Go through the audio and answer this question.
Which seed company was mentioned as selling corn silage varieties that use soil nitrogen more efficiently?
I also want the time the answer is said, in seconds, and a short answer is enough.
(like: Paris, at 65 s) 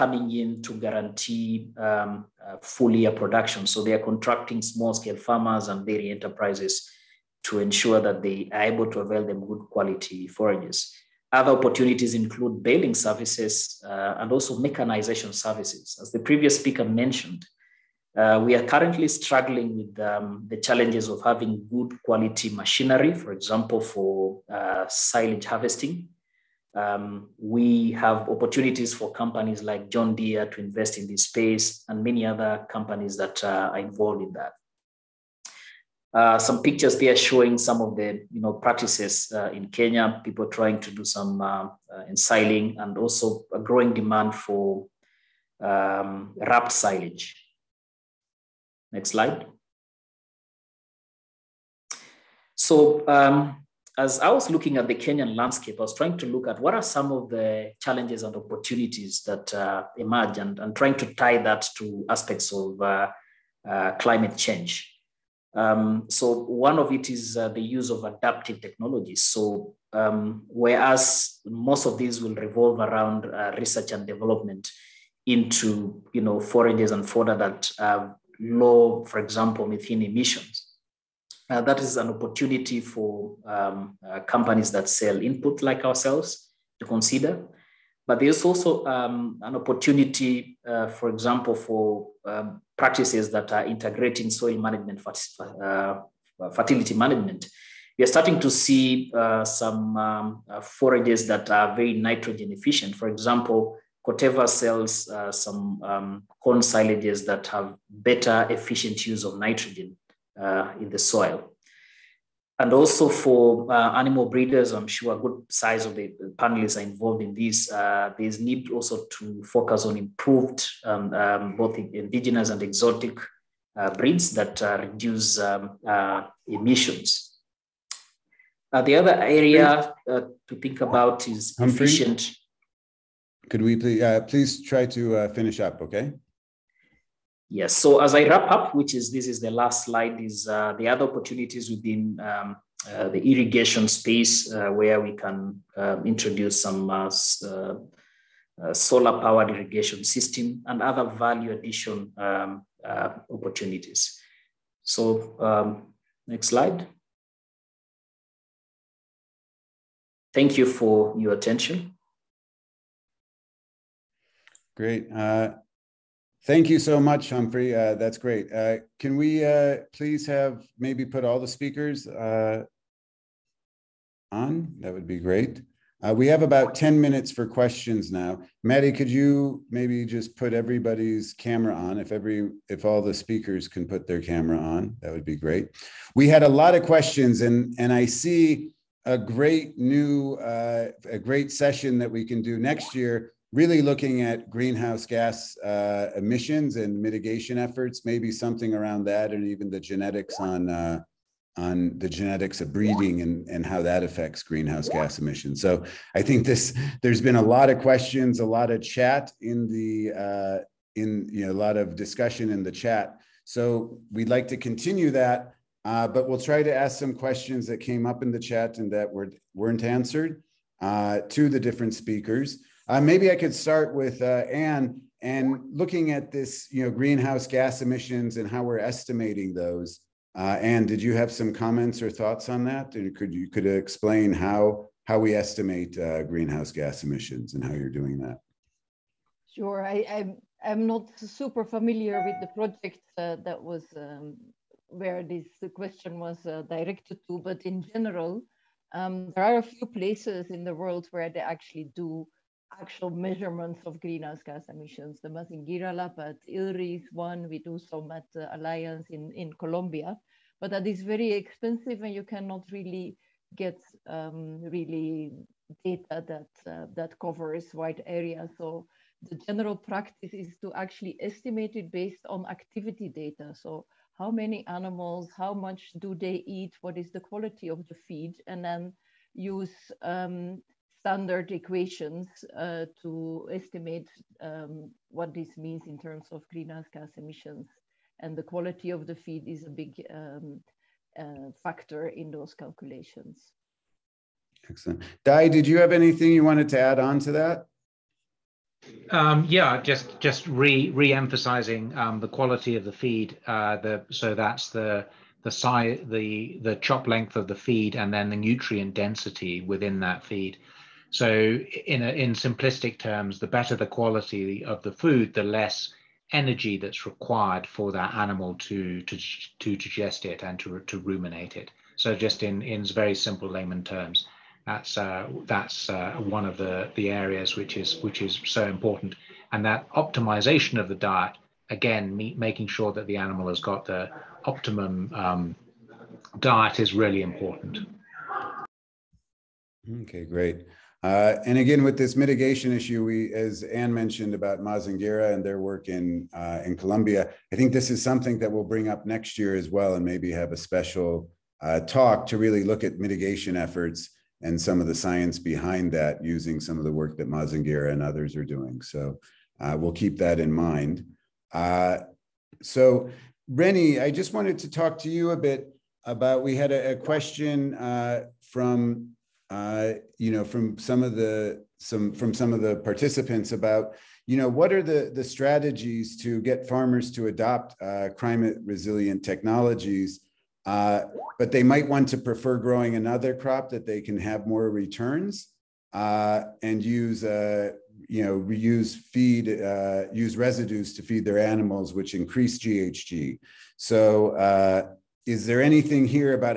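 Corteva, at 104 s.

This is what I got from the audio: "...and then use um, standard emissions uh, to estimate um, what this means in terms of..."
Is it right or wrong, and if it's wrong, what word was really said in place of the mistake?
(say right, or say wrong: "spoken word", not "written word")
wrong: "equations", not "emissions".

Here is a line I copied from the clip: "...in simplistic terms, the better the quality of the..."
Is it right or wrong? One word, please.
right.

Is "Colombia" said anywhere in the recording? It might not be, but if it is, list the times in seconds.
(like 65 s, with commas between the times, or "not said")
259 s, 346 s.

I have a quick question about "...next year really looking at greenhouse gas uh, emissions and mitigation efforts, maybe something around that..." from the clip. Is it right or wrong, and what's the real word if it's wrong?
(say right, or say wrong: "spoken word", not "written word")
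right.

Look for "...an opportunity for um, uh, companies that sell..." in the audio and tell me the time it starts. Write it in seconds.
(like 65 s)
81 s.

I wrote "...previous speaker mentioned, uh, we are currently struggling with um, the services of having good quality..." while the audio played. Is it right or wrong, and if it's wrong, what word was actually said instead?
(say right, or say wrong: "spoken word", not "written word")
wrong: "challenges", not "services".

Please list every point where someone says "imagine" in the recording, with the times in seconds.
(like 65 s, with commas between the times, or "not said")
not said.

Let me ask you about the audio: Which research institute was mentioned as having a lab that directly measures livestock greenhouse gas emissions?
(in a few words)
ILRI.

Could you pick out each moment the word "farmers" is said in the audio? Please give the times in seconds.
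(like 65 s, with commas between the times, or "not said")
5 s, 376 s.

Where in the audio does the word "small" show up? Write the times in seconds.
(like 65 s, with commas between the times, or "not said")
4 s.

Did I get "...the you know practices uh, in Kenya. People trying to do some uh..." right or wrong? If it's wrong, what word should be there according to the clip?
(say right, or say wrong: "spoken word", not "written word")
right.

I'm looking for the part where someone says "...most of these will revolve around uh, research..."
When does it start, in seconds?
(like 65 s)
71 s.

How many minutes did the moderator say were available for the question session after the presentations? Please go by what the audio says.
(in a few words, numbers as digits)
10.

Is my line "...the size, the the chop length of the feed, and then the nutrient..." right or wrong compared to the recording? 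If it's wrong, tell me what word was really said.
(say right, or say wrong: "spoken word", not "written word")
right.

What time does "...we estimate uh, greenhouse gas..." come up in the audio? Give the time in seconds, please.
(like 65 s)
235 s.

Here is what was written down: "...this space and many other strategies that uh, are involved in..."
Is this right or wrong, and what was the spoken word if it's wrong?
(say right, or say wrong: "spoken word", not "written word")
wrong: "companies", not "strategies".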